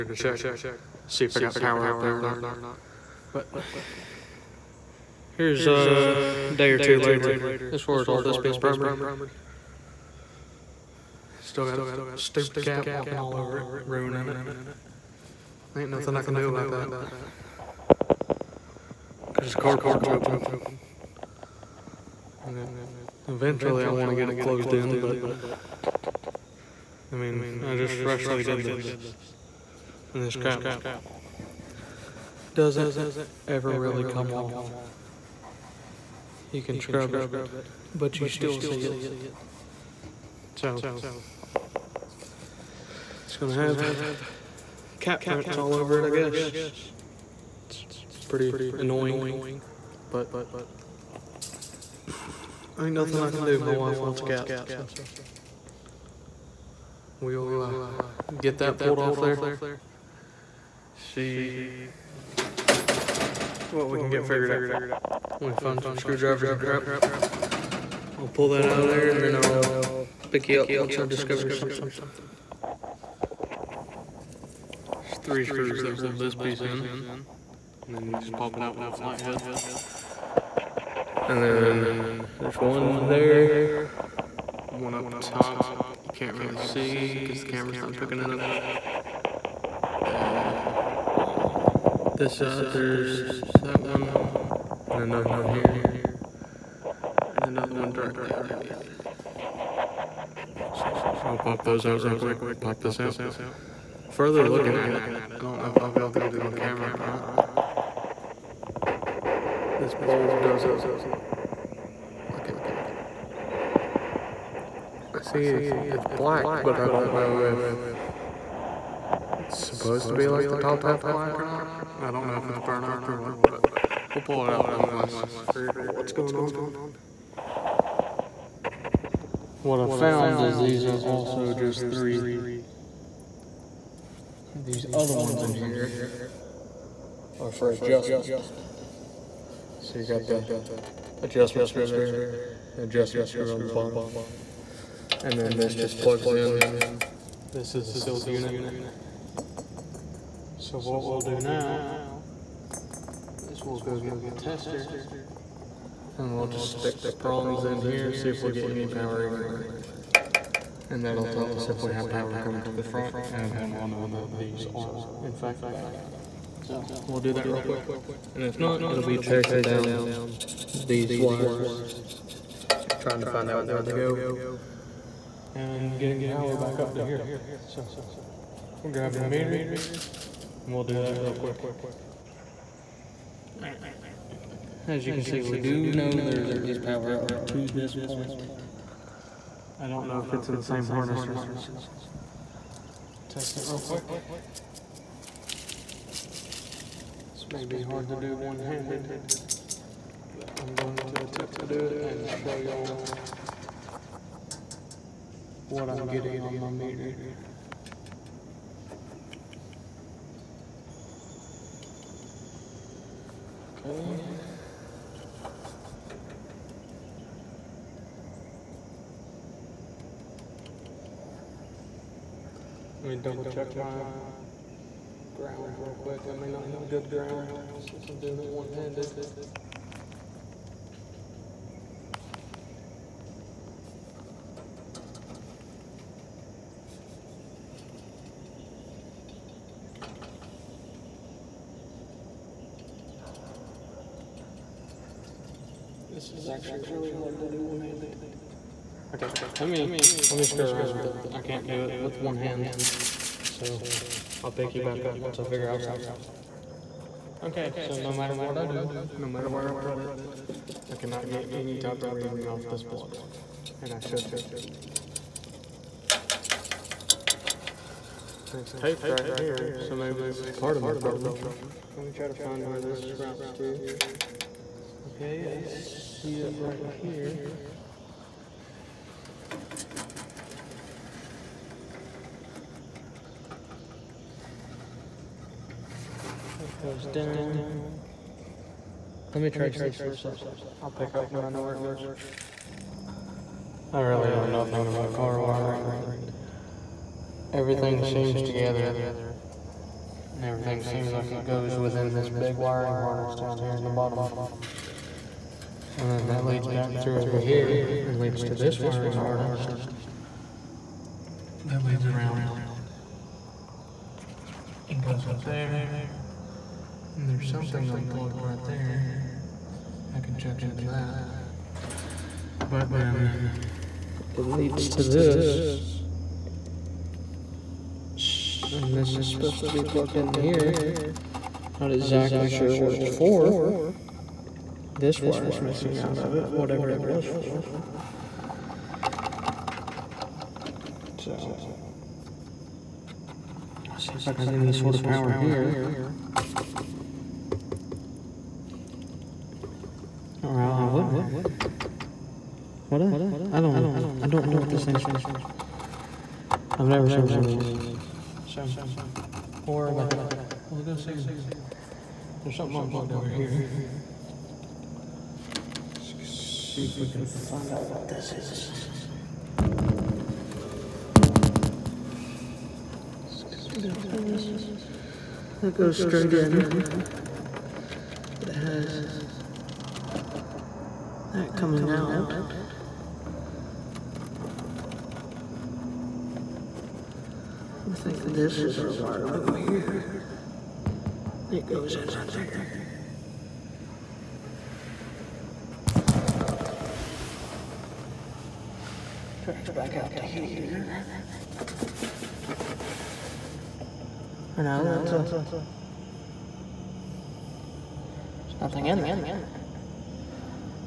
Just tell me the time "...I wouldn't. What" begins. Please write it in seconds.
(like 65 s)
350 s.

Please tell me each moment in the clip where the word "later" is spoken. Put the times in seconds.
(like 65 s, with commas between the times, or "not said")
6 s.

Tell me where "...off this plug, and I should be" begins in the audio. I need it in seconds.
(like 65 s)
262 s.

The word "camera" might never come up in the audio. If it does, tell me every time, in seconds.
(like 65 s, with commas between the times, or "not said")
87 s, 106 s.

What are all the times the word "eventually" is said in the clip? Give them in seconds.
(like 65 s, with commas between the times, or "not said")
23 s.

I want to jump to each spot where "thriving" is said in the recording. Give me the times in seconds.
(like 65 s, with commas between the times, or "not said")
not said.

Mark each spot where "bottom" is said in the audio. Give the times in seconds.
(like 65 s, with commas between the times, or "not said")
143 s, 303 s.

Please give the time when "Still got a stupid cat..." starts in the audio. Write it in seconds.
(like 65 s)
11 s.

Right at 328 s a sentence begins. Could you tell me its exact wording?
And this is supposed to be plugged in here.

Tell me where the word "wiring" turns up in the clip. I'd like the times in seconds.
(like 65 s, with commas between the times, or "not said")
295 s, 302 s, 308 s.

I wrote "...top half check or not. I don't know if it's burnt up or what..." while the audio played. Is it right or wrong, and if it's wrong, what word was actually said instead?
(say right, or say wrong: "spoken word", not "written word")
wrong: "black", not "check".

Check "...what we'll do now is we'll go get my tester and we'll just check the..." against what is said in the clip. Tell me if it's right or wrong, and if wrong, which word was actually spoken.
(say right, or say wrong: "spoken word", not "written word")
wrong: "stick", not "check".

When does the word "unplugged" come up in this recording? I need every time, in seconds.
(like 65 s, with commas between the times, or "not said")
317 s, 362 s.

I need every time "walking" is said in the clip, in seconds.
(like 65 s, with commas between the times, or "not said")
12 s.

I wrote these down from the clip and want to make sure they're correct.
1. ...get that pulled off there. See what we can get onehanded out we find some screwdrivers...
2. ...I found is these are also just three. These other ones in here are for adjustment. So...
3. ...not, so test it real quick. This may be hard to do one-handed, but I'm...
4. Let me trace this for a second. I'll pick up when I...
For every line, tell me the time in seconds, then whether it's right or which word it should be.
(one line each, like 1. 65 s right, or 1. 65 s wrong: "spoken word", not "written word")
1. 58 s wrong: "figured", not "onehanded"
2. 129 s right
3. 191 s right
4. 289 s right.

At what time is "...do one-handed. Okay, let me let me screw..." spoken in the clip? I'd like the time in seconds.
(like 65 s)
247 s.